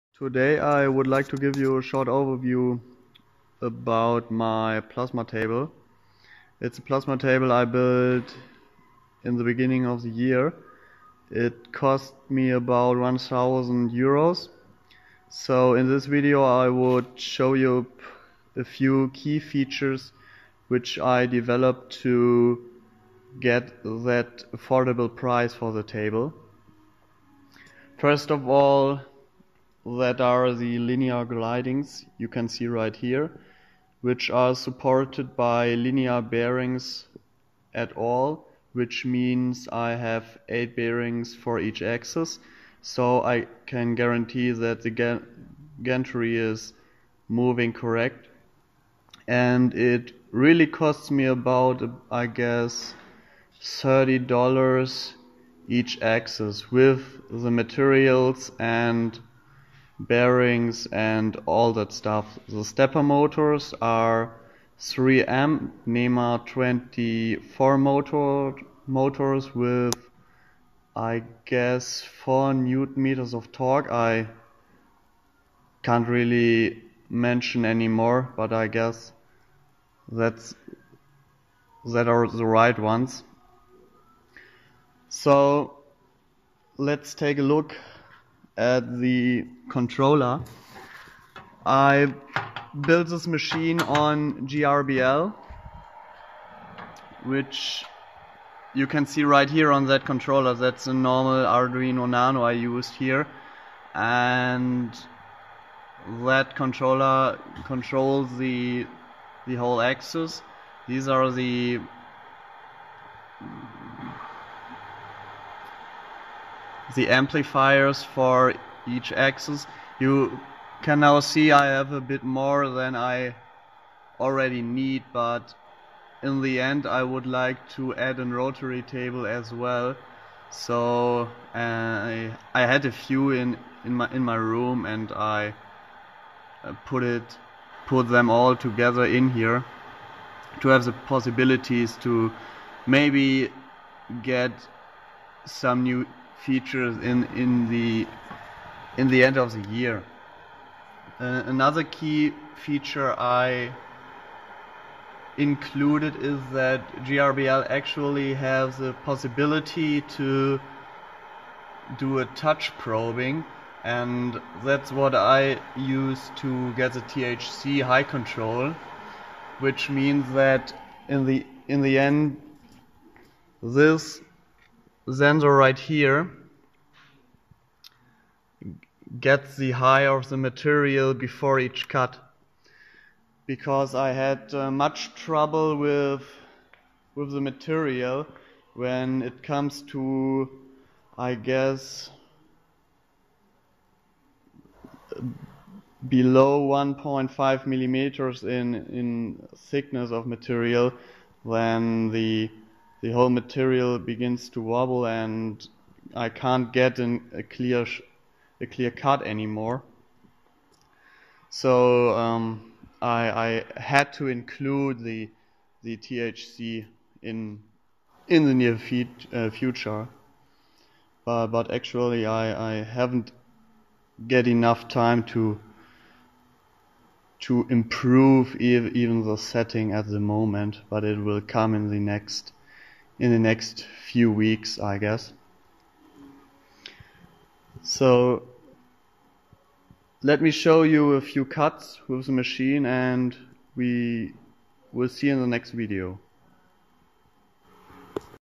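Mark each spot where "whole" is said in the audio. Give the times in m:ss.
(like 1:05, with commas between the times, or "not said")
1:49, 3:23.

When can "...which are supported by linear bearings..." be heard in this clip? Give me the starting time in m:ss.
0:34.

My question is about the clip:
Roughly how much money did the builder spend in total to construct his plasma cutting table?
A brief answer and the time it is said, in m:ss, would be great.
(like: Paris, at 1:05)
1000 euros, at 0:12.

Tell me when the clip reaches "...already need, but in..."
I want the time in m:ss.
2:04.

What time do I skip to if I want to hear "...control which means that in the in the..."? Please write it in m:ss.
2:48.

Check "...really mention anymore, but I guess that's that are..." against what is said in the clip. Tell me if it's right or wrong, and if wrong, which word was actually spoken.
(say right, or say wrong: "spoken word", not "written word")
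right.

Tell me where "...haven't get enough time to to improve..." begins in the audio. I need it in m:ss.
3:42.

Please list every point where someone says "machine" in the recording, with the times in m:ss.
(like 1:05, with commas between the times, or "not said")
1:33, 4:02.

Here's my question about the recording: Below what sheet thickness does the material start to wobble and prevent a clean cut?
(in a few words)
1.5 millimeters.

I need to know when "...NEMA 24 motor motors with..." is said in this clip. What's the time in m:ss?
1:05.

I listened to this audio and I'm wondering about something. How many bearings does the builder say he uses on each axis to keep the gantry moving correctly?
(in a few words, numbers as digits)
8.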